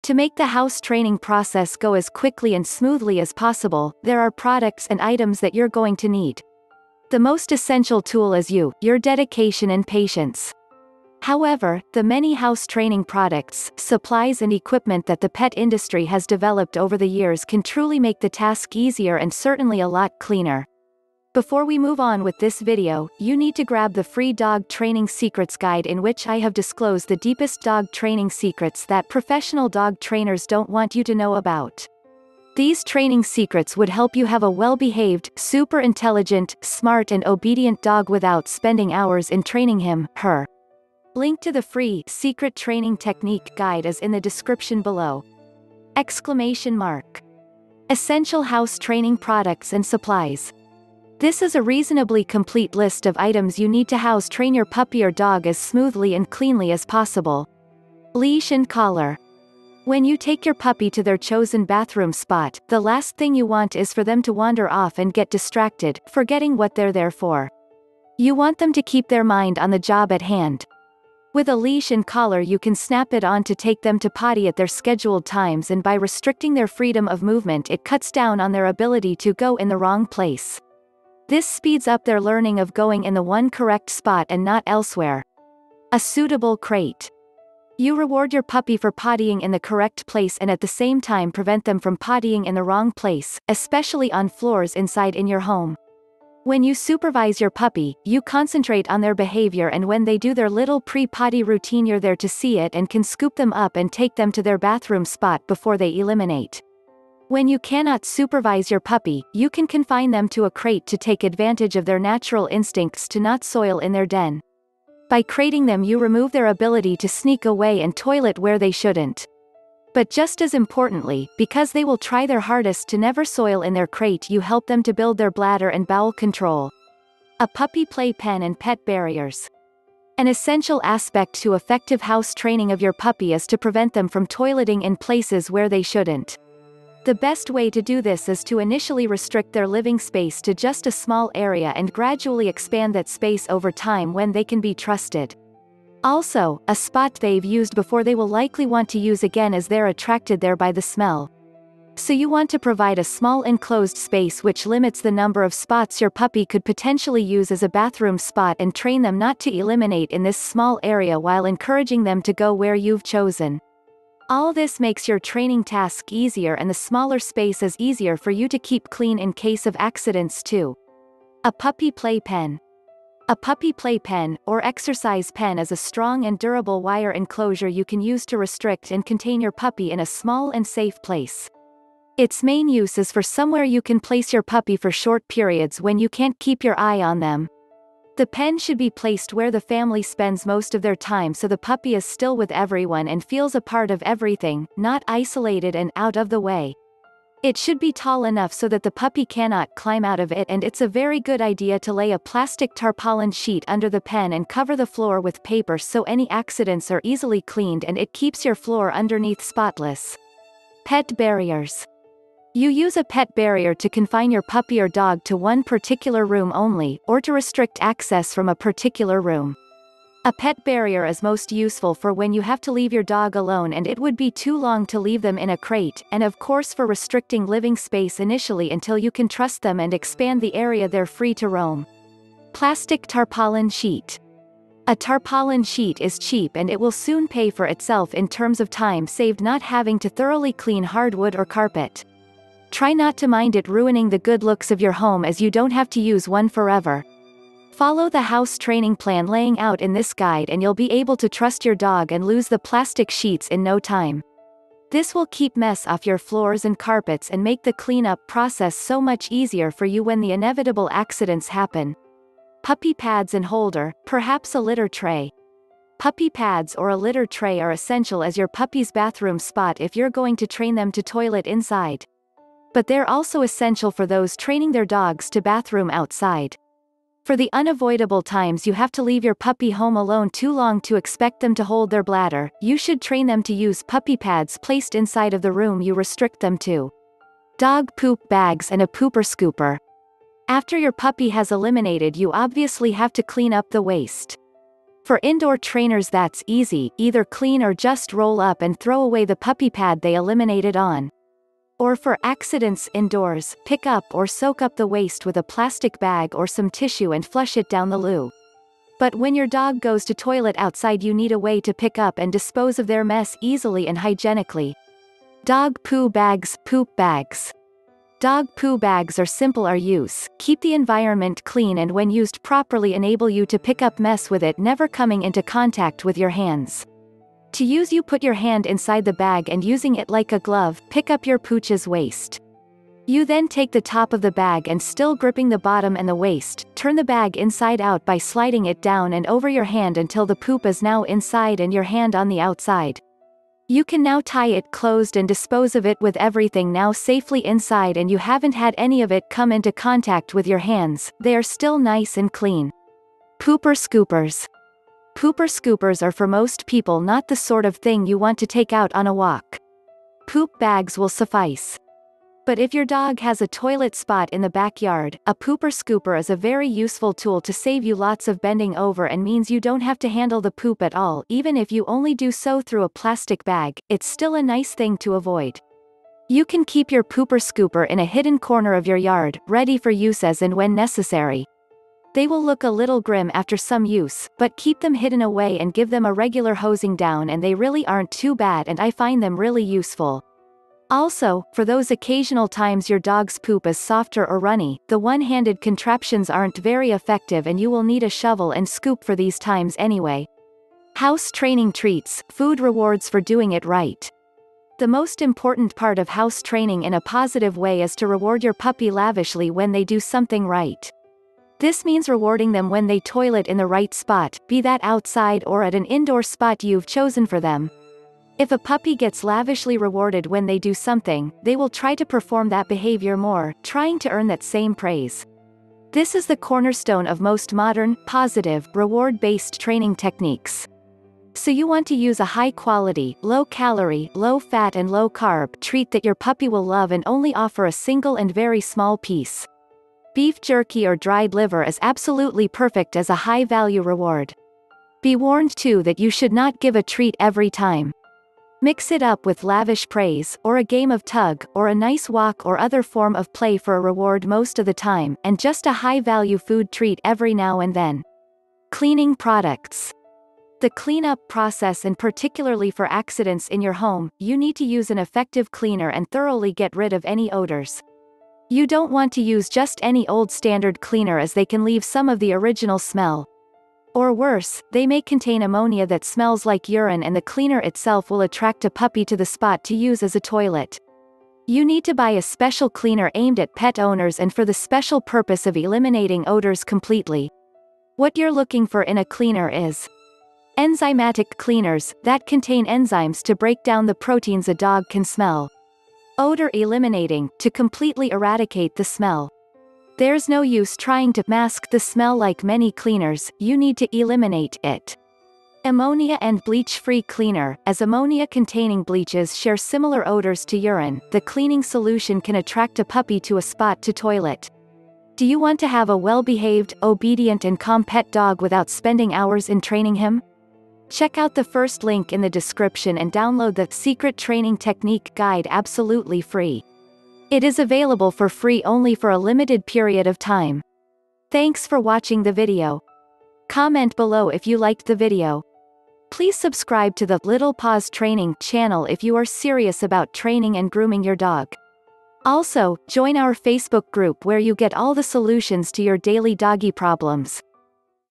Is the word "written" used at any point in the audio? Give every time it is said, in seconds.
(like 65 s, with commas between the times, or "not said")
not said.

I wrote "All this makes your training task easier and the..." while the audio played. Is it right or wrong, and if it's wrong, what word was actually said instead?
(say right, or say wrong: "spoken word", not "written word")
right.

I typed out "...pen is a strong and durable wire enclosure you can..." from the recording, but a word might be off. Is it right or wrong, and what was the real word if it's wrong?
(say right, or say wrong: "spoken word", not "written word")
right.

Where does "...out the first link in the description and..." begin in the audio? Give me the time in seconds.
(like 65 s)
521 s.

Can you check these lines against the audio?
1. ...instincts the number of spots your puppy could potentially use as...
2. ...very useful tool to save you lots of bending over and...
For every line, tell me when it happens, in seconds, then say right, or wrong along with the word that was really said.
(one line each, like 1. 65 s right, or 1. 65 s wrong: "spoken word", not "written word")
1. 154 s wrong: "limits", not "instincts"
2. 366 s right.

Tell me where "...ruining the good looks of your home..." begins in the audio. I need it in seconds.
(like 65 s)
243 s.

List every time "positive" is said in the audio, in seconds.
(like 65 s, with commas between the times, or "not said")
407 s, 428 s.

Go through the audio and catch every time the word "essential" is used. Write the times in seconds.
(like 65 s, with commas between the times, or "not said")
7 s, 47 s, 130 s, 267 s, 273 s.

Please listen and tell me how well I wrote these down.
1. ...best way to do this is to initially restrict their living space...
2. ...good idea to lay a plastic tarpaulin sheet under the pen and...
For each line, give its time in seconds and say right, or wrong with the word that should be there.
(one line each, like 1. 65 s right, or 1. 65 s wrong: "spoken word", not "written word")
1. 137 s right
2. 201 s right.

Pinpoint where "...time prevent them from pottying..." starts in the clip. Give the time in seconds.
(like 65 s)
91 s.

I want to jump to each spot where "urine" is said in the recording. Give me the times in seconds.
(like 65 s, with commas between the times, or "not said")
476 s, 510 s.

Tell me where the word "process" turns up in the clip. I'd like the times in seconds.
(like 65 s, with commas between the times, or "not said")
1 s, 258 s, 461 s.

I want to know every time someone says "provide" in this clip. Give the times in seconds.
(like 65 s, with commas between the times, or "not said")
152 s.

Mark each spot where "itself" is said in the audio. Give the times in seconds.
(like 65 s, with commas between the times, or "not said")
237 s, 477 s.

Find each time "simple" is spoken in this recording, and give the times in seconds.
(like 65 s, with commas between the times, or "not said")
319 s.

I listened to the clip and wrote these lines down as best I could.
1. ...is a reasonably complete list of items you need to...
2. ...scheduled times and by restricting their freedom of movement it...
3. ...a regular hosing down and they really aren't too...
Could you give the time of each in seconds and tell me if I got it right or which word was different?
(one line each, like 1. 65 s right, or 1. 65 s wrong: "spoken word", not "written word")
1. 51 s right
2. 74 s right
3. 386 s right.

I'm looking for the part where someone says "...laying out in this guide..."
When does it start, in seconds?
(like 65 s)
249 s.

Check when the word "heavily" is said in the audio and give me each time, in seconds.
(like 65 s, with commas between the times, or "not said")
not said.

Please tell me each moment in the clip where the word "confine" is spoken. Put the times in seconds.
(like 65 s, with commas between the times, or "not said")
109 s, 213 s.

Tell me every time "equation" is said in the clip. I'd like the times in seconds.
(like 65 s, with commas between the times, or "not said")
not said.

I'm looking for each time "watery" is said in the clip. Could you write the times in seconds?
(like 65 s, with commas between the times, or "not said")
not said.